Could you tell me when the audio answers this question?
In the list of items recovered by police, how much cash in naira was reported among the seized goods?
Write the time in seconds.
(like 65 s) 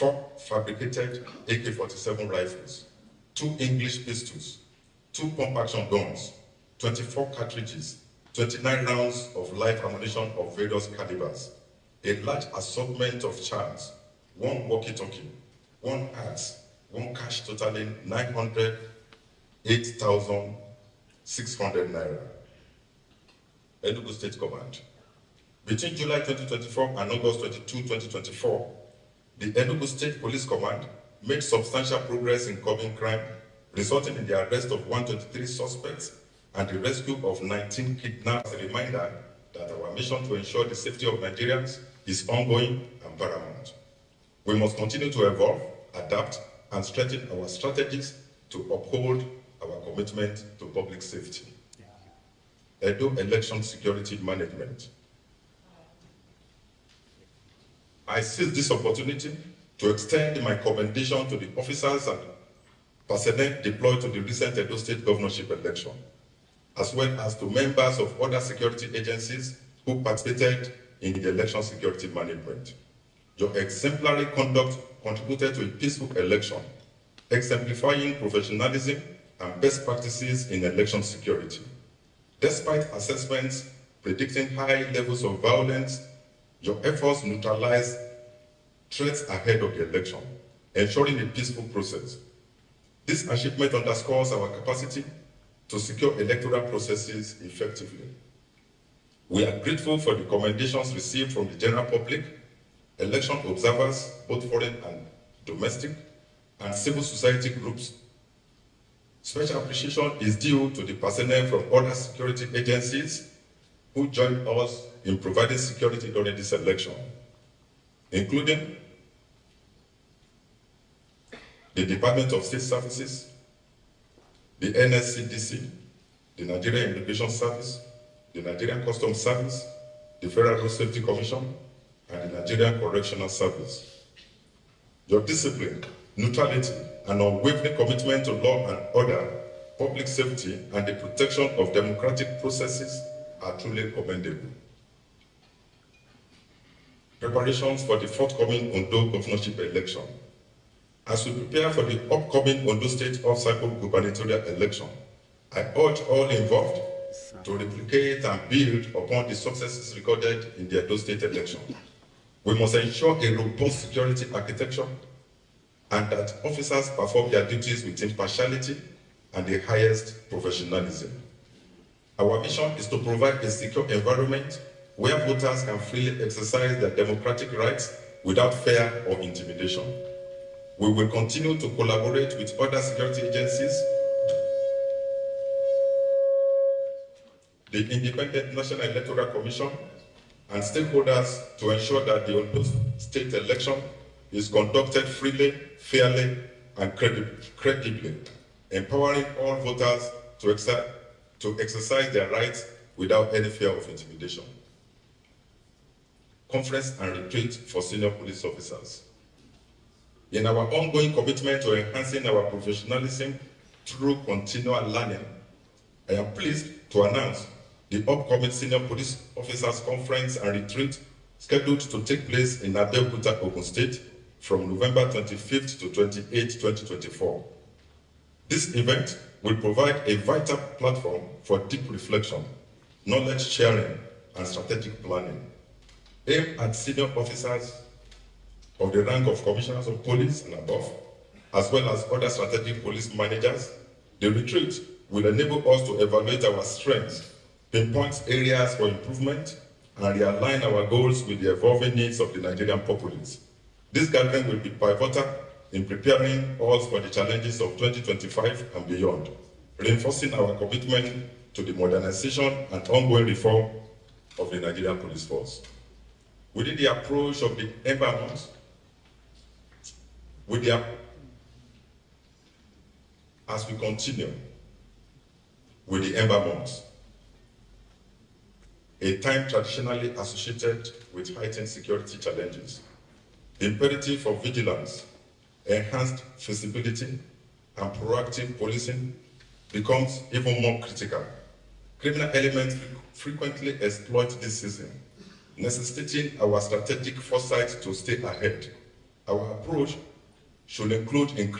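18 s.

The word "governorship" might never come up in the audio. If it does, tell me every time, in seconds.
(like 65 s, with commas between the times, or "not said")
65 s, 149 s.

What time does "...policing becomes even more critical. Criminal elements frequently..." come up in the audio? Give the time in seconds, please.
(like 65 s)
288 s.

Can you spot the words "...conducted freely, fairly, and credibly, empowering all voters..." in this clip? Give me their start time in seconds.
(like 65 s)
194 s.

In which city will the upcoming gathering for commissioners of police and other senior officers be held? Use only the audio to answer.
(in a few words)
Abeokuta.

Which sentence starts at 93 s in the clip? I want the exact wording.
This achievement underscores our capacity to secure electoral processes effectively.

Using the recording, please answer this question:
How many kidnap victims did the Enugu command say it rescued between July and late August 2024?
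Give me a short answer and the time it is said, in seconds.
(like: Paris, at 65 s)
19, at 37 s.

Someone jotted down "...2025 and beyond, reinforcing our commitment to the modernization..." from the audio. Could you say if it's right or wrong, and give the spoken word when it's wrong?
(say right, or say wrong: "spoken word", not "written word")
right.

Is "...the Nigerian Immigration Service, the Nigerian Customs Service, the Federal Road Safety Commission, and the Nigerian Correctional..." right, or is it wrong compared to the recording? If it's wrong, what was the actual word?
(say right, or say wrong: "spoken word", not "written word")
right.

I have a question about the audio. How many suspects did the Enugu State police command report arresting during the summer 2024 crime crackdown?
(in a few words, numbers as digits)
123.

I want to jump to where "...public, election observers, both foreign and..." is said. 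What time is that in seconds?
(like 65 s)
101 s.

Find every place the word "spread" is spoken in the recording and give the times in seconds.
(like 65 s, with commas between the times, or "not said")
not said.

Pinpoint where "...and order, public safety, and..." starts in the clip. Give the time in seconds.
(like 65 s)
138 s.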